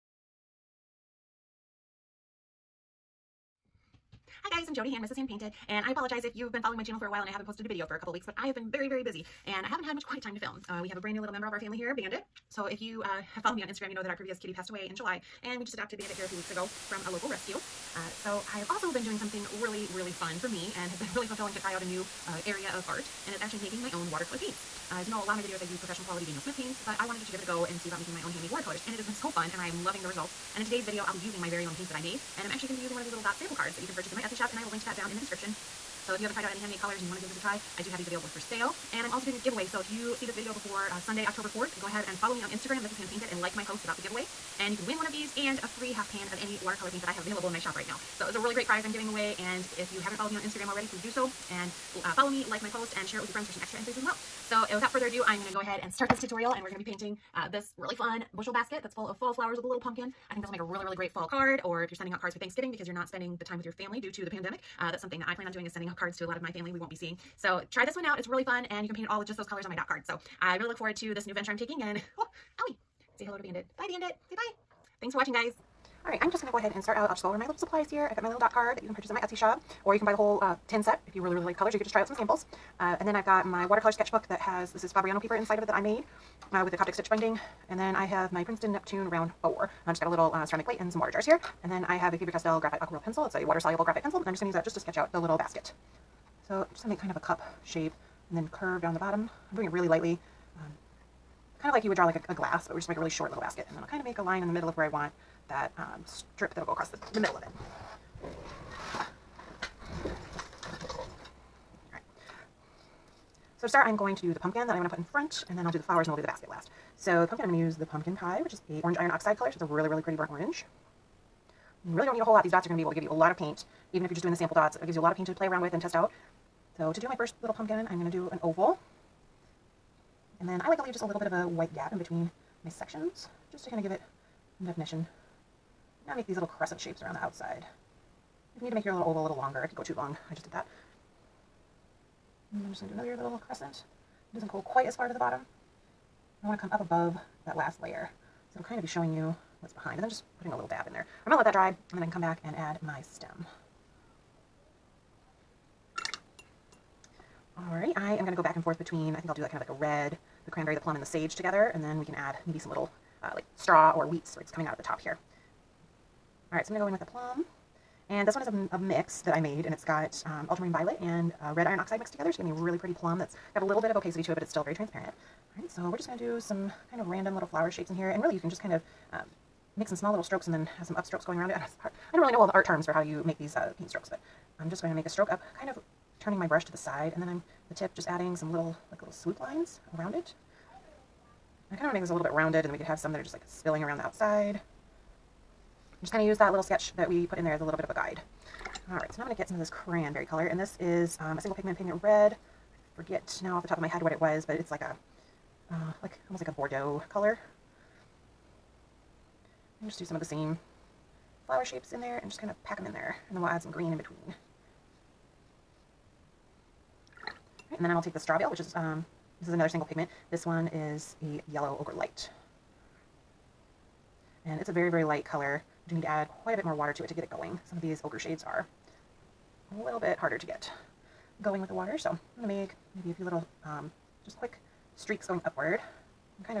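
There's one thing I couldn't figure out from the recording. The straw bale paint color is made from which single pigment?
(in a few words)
yellow ochre light.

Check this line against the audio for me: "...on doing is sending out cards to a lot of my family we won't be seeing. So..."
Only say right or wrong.
right.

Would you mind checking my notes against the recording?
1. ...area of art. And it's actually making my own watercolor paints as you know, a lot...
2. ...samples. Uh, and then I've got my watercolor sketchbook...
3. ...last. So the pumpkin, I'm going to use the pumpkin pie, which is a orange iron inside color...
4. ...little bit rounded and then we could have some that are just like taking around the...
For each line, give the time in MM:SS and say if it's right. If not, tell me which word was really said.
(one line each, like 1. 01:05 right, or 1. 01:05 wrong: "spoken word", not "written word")
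1. 00:22 right
2. 01:22 right
3. 01:56 wrong: "oxide", not "inside"
4. 03:12 wrong: "spilling", not "taking".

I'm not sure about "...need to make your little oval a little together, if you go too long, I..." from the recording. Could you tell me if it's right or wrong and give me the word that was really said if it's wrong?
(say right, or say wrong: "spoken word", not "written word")
wrong: "longer", not "together".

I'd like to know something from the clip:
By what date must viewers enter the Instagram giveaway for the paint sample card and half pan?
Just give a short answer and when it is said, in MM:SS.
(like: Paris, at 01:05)
Sunday, October 4th, at 00:41.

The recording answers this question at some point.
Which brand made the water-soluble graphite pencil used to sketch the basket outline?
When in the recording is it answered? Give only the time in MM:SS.
01:32.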